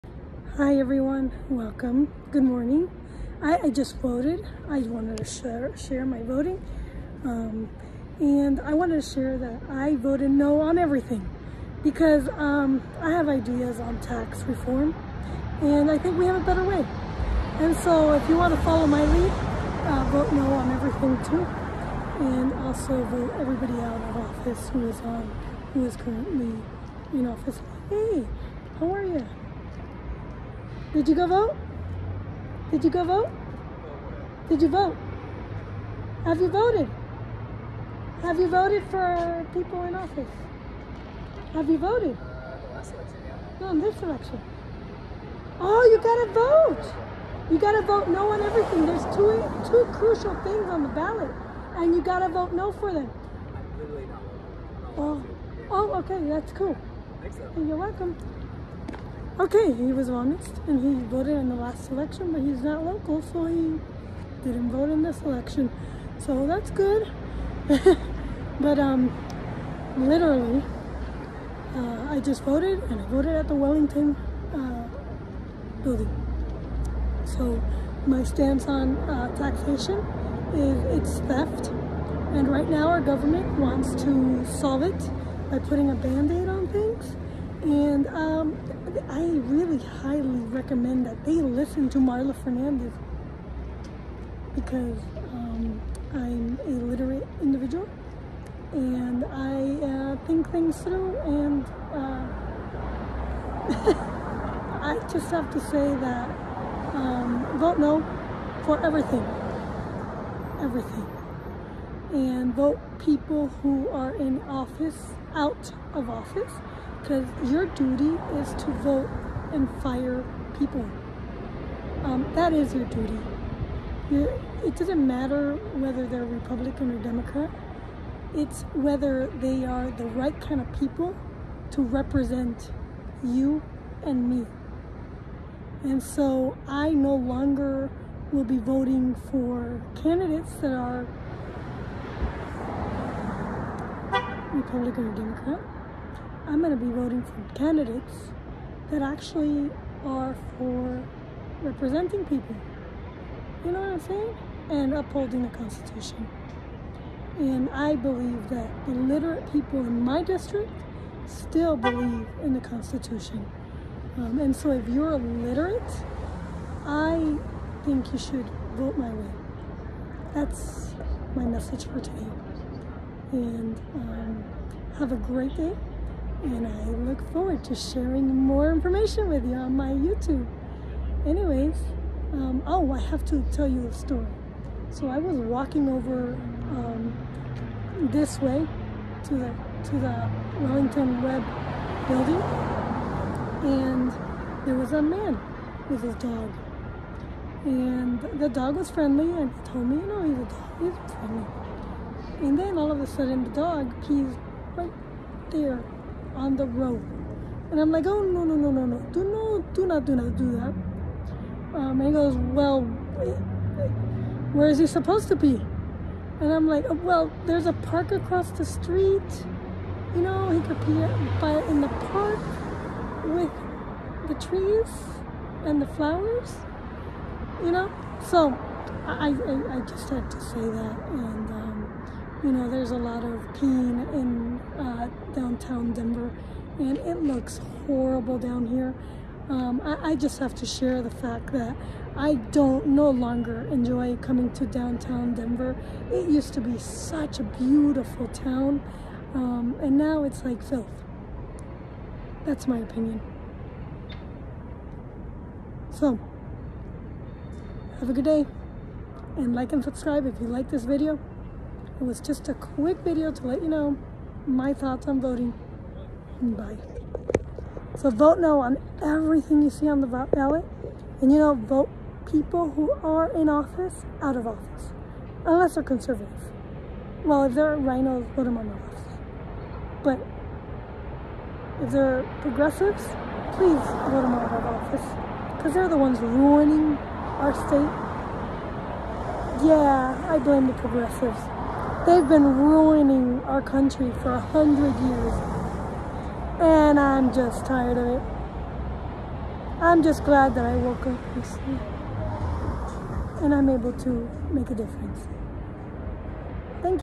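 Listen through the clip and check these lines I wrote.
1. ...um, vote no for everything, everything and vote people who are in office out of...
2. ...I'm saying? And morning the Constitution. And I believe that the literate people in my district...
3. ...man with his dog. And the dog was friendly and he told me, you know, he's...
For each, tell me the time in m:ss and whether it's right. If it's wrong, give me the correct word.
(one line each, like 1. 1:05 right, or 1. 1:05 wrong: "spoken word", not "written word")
1. 1:46 right
2. 2:33 wrong: "upholding", not "morning"
3. 3:15 right.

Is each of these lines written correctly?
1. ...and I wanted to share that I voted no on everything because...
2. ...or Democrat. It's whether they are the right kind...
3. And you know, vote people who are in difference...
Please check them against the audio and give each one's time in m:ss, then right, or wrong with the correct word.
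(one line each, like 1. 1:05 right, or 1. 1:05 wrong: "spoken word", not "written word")
1. 0:08 right
2. 2:06 right
3. 4:31 wrong: "office", not "difference".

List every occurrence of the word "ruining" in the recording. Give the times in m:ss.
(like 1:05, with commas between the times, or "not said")
4:46, 4:52.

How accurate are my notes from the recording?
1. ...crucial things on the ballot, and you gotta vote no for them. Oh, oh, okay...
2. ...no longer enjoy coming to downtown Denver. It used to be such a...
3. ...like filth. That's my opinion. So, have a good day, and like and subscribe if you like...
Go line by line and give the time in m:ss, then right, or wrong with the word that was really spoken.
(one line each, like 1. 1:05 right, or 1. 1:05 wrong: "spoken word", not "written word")
1. 0:49 right
2. 4:02 right
3. 4:10 right.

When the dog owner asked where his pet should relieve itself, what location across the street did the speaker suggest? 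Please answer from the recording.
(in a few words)
A park.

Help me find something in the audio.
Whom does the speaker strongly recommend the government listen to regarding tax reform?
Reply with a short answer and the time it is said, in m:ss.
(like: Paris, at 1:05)
Marla Fernandez, at 1:31.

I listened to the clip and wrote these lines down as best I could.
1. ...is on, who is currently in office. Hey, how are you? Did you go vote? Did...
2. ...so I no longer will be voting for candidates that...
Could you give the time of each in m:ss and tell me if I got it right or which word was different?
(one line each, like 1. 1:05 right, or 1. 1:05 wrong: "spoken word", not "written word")
1. 0:24 right
2. 2:16 right.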